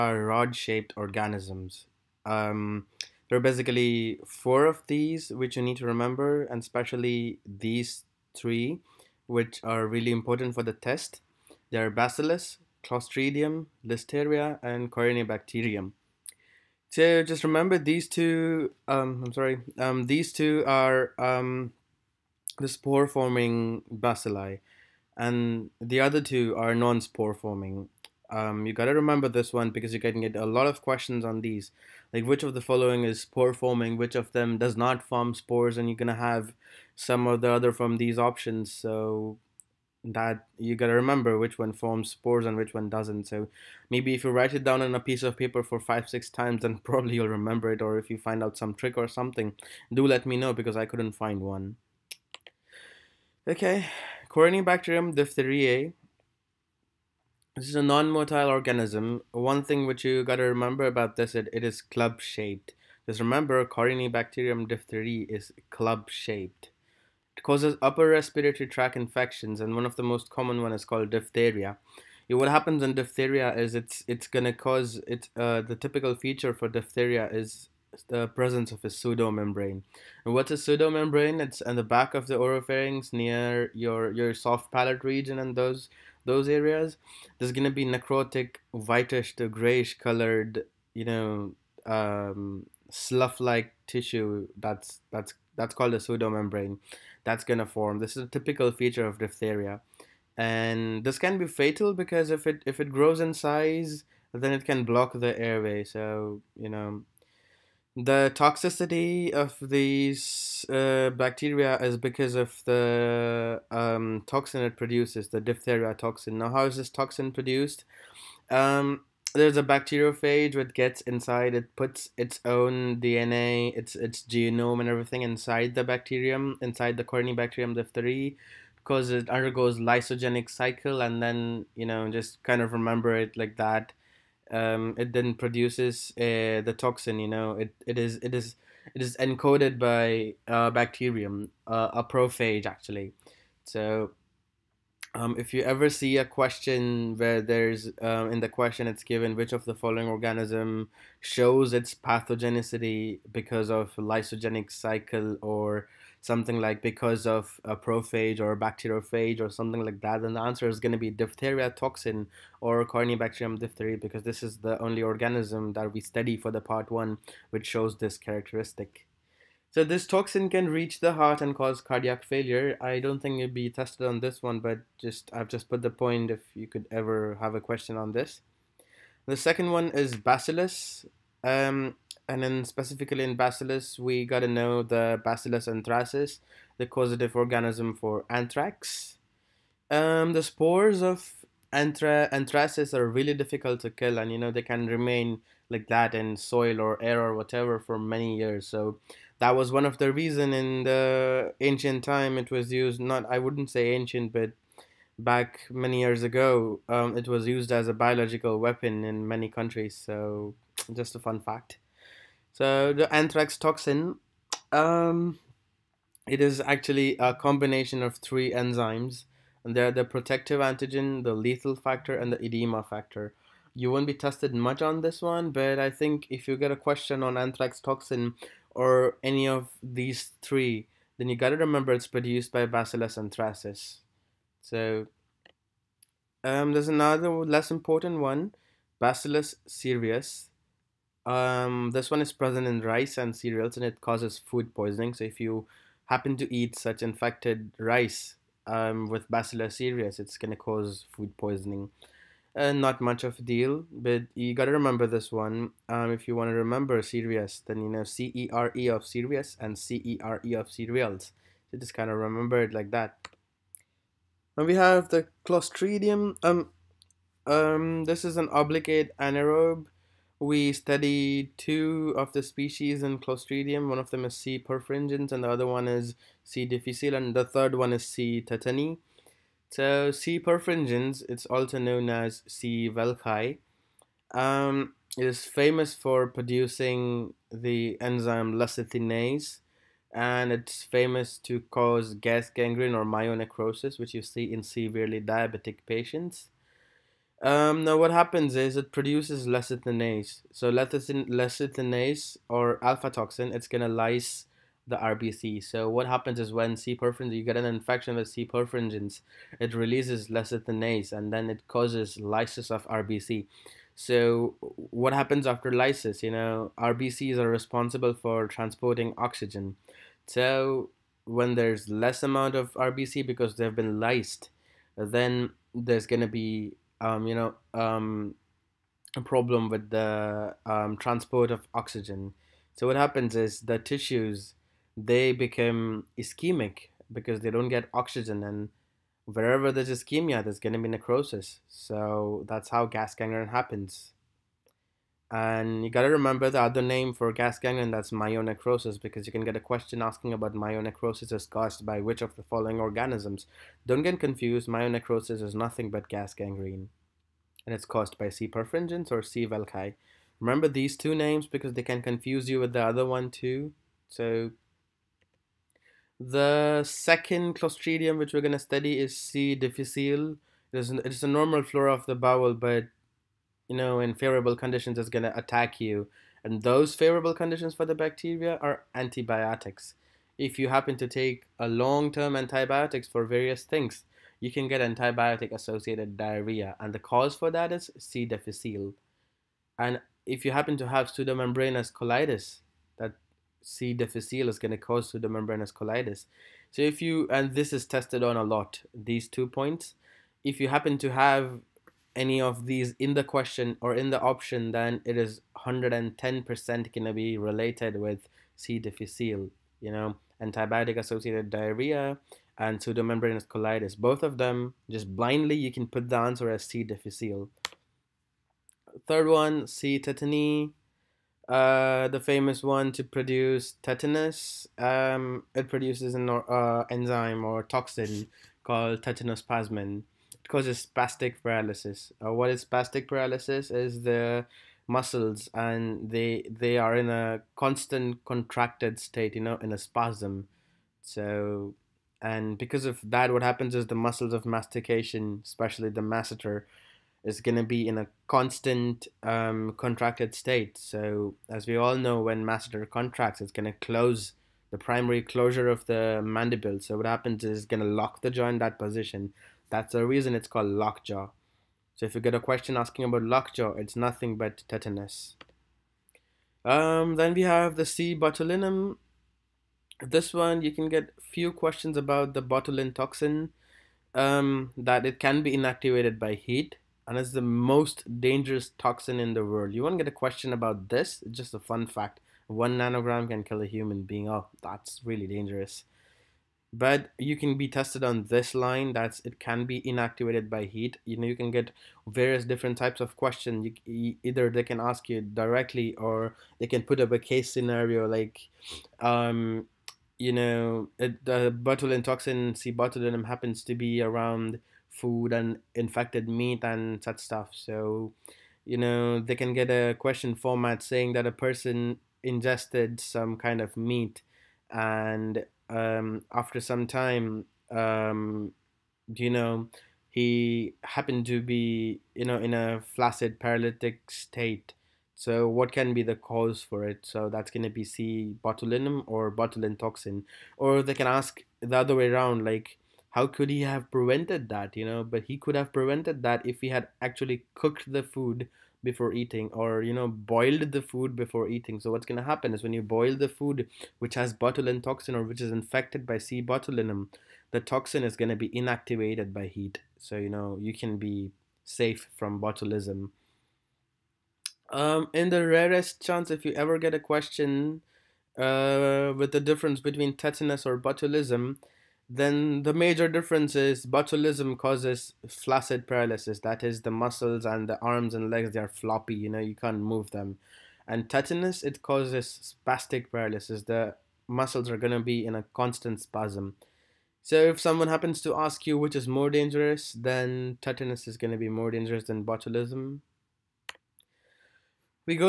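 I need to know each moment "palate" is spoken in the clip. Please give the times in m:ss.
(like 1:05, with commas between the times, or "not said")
1:24.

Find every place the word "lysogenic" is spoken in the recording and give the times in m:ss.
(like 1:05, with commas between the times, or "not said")
2:09, 2:33.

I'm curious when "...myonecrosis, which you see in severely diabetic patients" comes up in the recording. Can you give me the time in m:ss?
4:53.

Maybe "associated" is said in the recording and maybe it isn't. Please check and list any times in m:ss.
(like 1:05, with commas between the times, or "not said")
6:24, 6:50.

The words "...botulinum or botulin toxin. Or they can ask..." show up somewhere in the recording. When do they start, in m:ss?
8:48.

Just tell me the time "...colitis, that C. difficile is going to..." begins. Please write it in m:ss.
6:31.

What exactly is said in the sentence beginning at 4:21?
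So just kind of remember it like that.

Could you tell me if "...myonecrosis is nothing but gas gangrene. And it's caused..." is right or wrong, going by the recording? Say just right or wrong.
right.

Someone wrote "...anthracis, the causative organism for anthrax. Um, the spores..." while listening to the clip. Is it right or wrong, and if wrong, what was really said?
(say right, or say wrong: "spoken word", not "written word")
right.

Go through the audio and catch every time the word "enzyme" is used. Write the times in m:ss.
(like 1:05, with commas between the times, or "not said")
3:38, 4:47, 7:06.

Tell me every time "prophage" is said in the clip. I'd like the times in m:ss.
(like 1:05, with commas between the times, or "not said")
2:22, 2:37.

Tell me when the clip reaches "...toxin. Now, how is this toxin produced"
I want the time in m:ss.
1:55.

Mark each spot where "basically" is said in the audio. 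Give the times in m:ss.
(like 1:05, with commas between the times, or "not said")
0:03.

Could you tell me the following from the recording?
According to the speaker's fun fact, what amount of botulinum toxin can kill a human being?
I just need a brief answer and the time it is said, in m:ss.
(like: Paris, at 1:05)
1 nanogram, at 8:02.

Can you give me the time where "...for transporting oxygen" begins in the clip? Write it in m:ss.
5:18.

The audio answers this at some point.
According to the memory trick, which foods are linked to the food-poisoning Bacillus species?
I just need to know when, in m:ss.
4:02.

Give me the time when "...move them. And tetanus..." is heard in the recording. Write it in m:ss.
9:29.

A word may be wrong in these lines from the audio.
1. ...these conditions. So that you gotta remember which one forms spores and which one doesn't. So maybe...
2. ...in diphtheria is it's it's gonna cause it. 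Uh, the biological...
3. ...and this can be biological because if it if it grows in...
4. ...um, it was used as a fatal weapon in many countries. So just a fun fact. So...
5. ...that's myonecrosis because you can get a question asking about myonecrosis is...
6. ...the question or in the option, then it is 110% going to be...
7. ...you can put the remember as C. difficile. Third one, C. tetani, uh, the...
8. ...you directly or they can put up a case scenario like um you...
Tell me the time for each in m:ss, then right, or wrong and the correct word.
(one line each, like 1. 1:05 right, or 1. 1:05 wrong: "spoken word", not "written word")
1. 0:37 wrong: "options", not "conditions"
2. 1:12 wrong: "typical", not "biological"
3. 1:40 wrong: "fatal", not "biological"
4. 3:26 wrong: "biological", not "fatal"
5. 5:47 right
6. 6:43 right
7. 6:55 wrong: "answer", not "remember"
8. 8:15 right.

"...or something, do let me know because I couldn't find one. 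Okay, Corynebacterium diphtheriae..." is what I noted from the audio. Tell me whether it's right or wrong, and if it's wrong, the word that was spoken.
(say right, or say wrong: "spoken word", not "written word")
right.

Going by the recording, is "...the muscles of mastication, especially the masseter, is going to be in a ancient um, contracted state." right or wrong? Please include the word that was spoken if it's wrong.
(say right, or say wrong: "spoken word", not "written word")
wrong: "constant", not "ancient".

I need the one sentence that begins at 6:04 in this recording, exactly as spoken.
So the second clostridium which we're gonna study is C.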